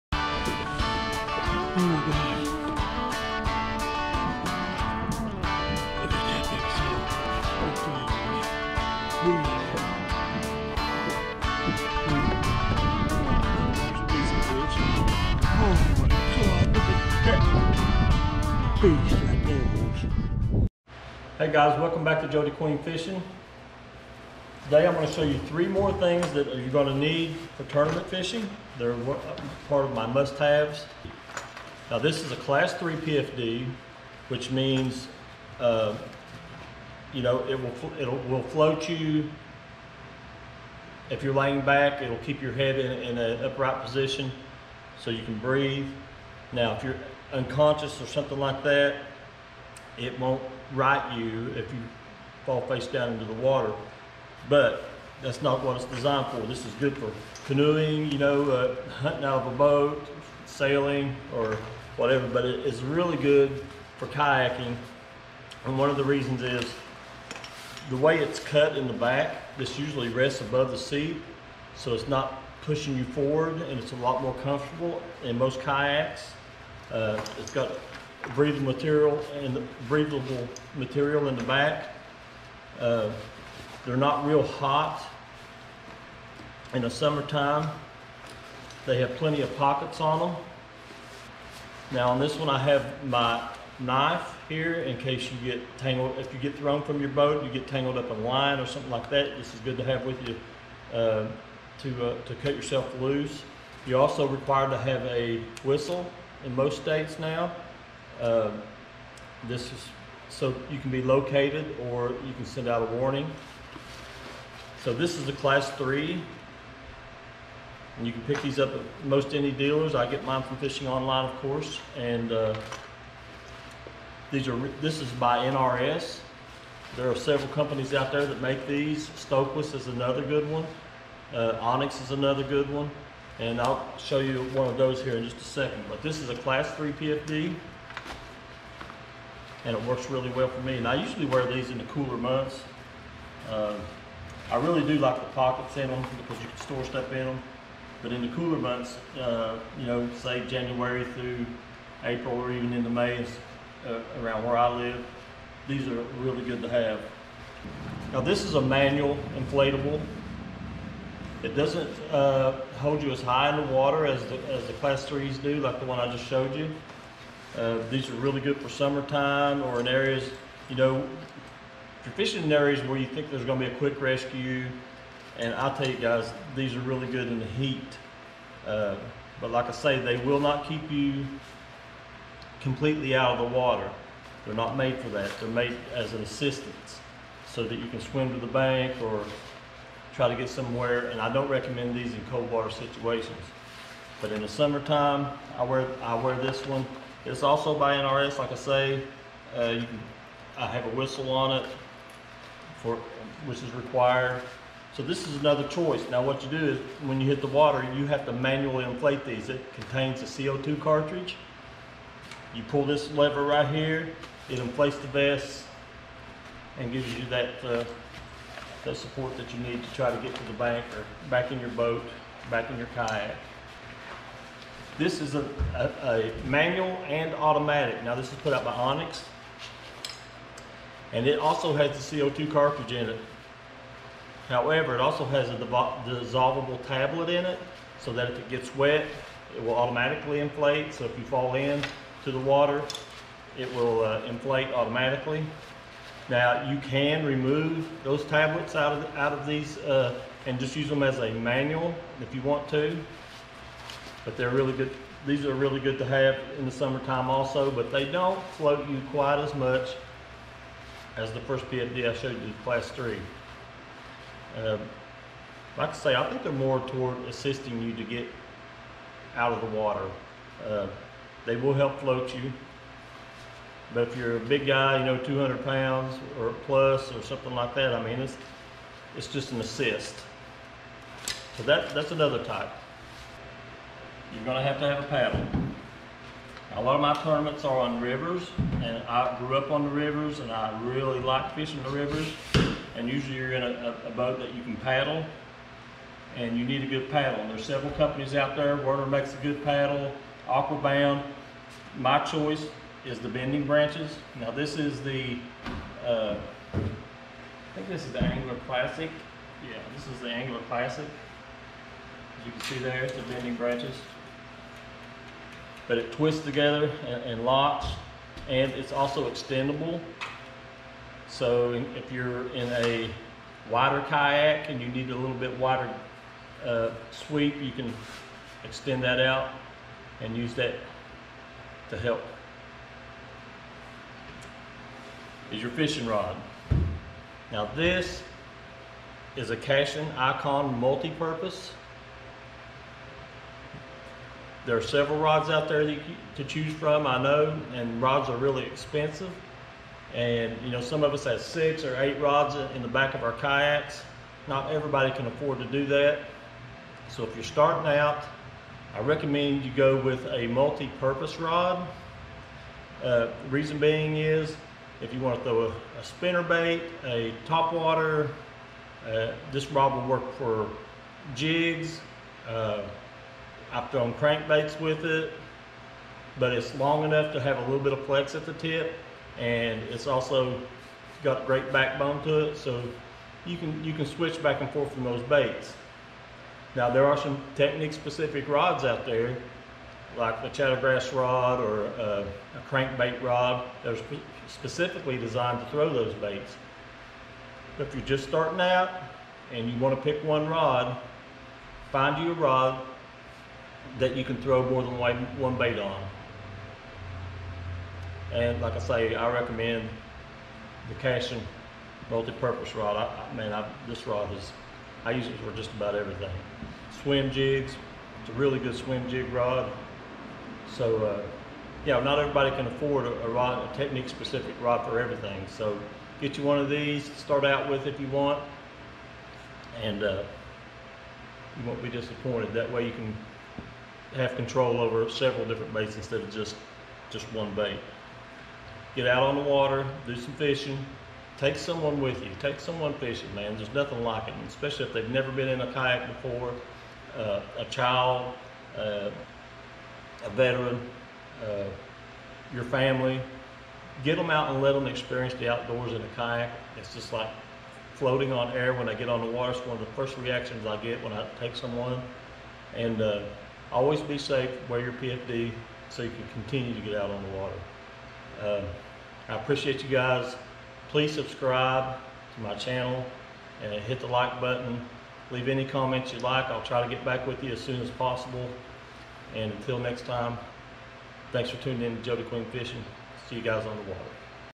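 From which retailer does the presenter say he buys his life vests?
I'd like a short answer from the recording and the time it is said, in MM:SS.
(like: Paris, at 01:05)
Fishing Online, at 02:00.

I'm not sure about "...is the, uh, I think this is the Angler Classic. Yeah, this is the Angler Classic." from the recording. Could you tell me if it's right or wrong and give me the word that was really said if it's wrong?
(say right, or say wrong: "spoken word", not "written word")
right.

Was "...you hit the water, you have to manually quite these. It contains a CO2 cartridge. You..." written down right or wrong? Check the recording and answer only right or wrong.
wrong.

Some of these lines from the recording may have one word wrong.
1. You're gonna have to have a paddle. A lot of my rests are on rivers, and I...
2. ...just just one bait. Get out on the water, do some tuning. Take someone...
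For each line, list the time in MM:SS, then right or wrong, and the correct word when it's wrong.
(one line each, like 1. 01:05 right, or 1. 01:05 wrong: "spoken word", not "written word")
1. 04:44 wrong: "tournaments", not "rests"
2. 07:16 wrong: "fishing", not "tuning".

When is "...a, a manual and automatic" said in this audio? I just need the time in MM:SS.
03:45.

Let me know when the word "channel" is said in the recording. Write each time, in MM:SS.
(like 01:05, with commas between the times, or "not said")
07:52.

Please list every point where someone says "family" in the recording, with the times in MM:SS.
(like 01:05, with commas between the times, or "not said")
07:32.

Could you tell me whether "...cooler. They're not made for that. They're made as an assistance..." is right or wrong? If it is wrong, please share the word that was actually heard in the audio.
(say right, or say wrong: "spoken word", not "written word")
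wrong: "water", not "cooler".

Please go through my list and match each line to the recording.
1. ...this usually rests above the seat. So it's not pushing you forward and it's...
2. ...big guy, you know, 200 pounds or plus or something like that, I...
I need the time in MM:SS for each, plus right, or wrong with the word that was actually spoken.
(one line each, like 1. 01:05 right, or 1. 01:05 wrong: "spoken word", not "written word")
1. 01:09 right
2. 04:34 right.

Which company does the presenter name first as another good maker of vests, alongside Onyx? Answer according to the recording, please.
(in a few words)
Stohlquist.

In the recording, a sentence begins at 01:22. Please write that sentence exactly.
Uh, they're not real hot in the summertime.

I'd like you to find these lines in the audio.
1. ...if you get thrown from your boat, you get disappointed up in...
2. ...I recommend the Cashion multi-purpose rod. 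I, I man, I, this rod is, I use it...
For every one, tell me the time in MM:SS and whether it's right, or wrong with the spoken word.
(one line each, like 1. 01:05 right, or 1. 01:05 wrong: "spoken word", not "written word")
1. 01:36 wrong: "tangled", not "disappointed"
2. 06:49 right.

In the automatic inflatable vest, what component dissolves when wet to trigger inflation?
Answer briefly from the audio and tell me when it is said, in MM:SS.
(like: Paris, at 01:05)
tablet, at 03:56.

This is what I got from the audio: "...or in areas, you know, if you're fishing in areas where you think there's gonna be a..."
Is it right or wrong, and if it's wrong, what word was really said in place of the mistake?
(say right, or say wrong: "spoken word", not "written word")
right.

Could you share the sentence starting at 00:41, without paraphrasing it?
If you're laying back, it'll keep your head in, in an upright position so you can breathe.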